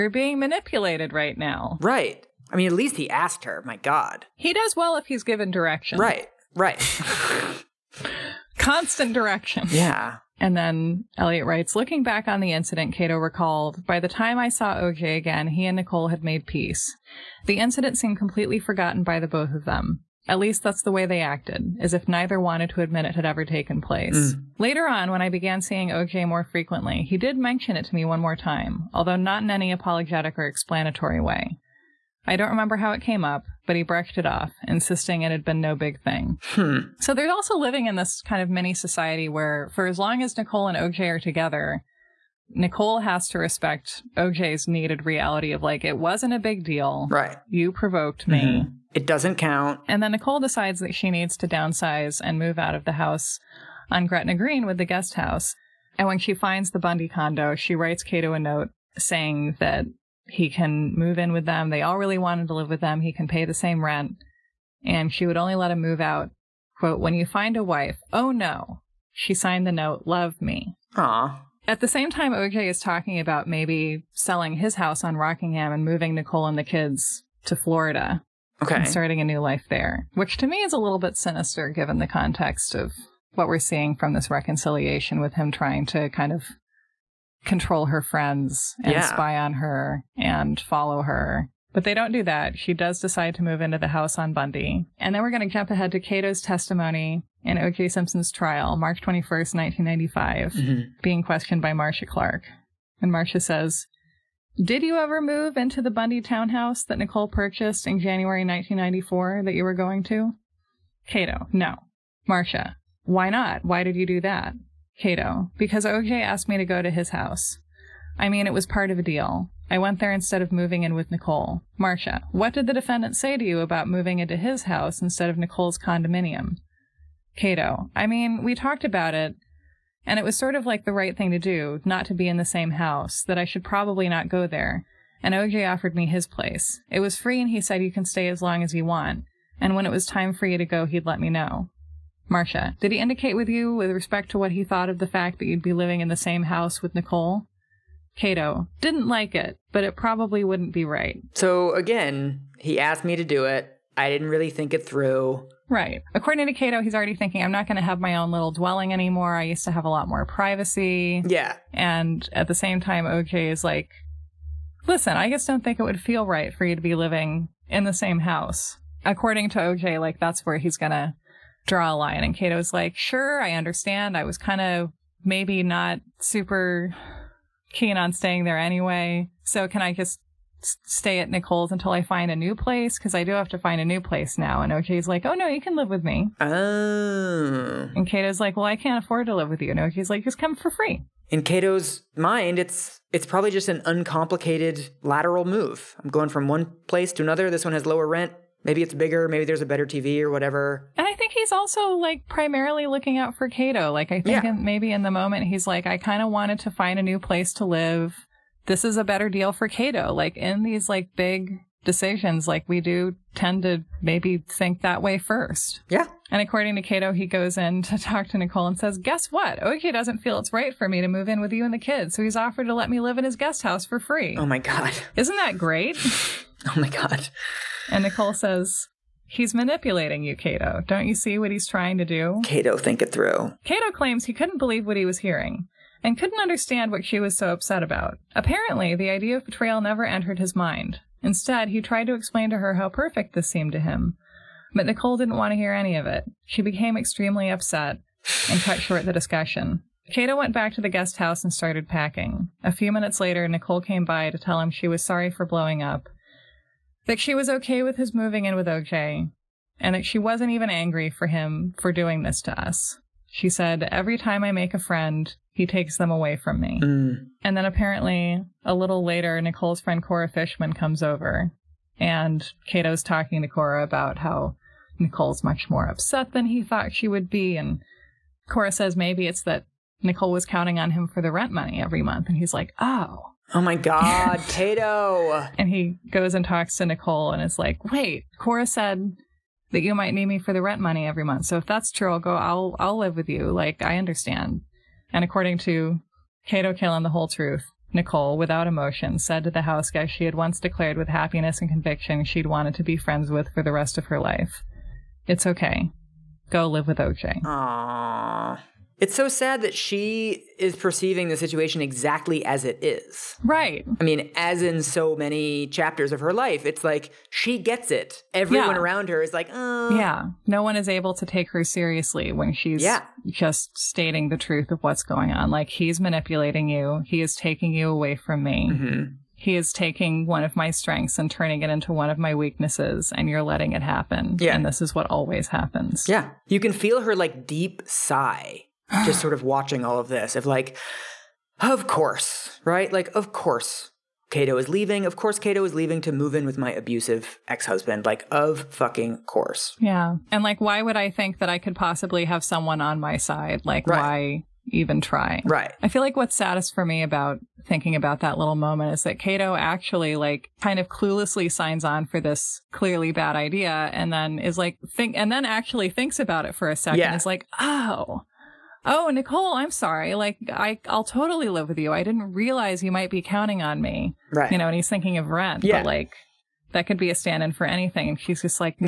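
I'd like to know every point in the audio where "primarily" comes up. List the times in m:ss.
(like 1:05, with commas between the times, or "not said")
3:22.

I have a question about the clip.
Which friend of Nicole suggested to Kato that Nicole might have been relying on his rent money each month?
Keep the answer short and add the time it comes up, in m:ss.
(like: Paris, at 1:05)
Cora Fischman, at 4:30.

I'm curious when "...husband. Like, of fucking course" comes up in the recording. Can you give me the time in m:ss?
5:47.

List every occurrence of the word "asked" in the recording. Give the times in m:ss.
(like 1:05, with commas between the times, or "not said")
0:03, 1:56, 2:32.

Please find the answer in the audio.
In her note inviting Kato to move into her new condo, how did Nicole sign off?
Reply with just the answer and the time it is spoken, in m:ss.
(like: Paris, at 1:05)
love me, at 1:10.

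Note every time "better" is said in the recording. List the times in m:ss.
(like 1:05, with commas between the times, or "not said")
3:19, 3:29.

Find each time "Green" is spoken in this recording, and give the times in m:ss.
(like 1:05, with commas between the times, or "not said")
0:54.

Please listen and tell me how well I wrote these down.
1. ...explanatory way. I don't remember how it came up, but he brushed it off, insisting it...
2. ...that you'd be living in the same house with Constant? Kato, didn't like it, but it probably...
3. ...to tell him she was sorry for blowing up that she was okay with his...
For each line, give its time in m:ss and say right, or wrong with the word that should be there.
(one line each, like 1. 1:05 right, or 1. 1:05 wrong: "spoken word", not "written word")
1. 0:30 right
2. 2:25 wrong: "Nicole", not "Constant"
3. 4:14 right.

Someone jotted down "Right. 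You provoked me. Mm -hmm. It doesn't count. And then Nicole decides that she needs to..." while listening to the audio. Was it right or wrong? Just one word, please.
right.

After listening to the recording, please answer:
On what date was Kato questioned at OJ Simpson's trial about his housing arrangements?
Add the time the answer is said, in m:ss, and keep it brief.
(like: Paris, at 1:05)
March 21st, 1995, at 1:38.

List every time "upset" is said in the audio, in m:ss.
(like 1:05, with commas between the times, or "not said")
3:57, 4:07, 4:35.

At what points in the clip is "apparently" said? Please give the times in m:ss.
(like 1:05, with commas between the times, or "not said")
3:58, 4:27.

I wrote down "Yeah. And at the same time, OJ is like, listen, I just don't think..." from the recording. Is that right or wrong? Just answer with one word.
right.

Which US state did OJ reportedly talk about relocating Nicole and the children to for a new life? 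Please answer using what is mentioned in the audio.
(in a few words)
Florida.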